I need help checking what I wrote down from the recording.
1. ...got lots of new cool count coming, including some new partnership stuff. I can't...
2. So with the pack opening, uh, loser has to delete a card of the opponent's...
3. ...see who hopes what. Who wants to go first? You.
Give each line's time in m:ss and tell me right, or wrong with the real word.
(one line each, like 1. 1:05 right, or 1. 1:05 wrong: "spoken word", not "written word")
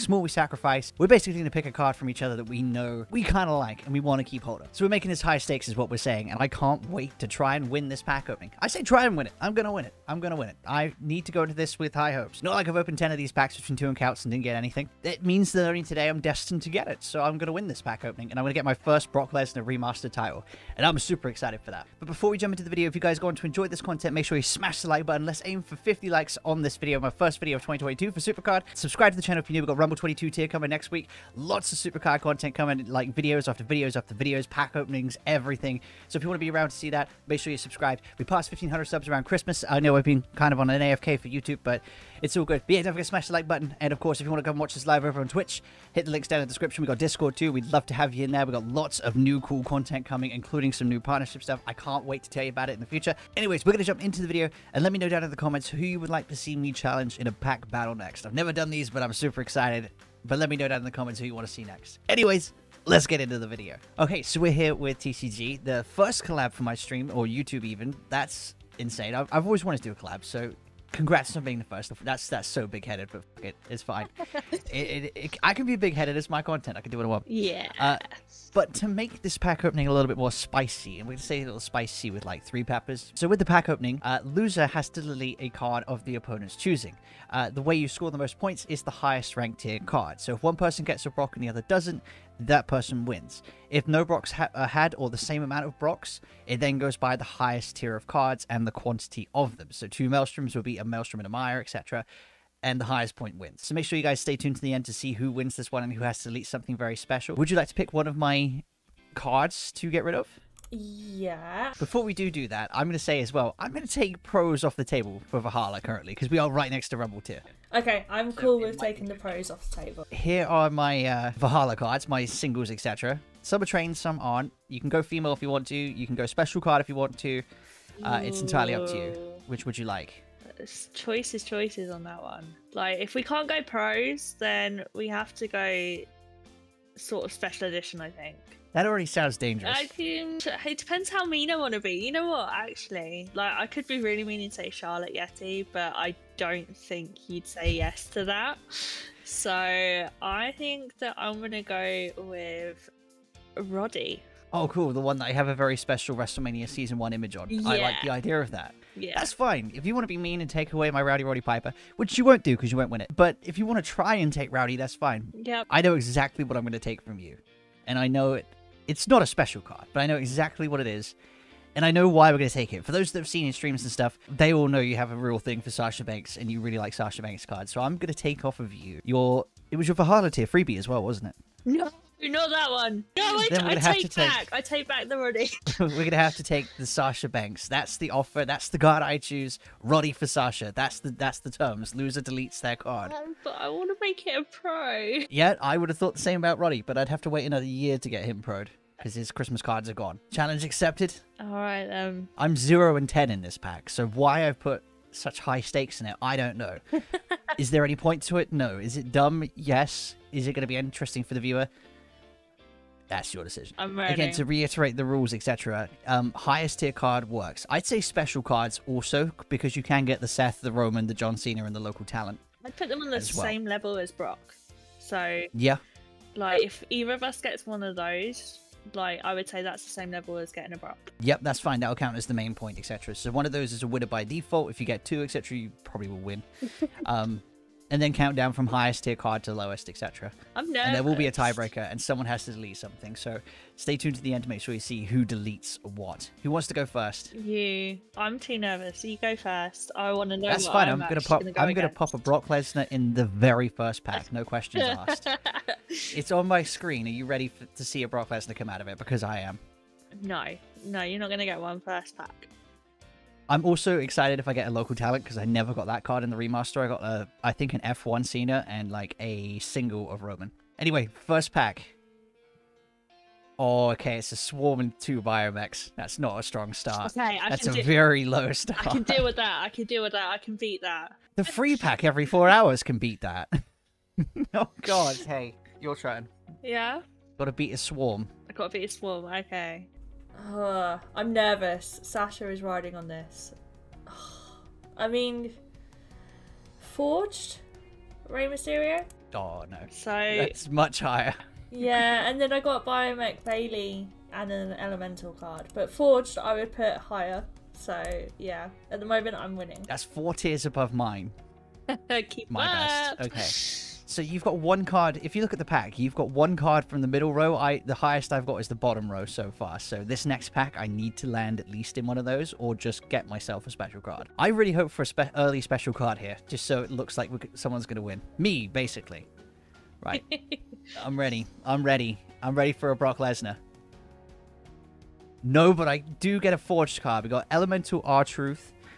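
1. 0:48 wrong: "content", not "count"
2. 1:23 right
3. 4:04 wrong: "deletes", not "hopes".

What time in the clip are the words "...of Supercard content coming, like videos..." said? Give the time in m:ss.
0:31.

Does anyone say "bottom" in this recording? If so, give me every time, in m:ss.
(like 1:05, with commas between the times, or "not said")
5:18.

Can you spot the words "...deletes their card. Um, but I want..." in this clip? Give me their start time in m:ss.
3:12.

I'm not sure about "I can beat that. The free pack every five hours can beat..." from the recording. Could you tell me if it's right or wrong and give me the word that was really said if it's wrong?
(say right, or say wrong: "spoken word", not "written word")
wrong: "four", not "five".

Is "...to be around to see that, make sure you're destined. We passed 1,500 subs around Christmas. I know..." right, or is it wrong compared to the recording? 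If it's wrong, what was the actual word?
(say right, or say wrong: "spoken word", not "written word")
wrong: "subscribed", not "destined".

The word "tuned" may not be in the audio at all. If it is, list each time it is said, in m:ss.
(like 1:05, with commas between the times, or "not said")
1:44, 4:03.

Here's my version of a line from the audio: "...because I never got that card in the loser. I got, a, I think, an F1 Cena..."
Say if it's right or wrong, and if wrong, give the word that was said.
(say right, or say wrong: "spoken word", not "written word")
wrong: "remaster", not "loser".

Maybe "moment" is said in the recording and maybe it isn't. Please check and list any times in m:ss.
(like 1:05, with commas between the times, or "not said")
5:09.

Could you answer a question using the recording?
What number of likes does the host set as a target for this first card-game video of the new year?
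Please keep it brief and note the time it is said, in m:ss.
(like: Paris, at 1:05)
50, at 0:25.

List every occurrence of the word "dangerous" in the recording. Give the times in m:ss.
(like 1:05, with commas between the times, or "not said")
2:19.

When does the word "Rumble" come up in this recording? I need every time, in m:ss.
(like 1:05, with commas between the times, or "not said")
0:29, 1:56.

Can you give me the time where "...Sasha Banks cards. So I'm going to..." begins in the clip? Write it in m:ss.
2:56.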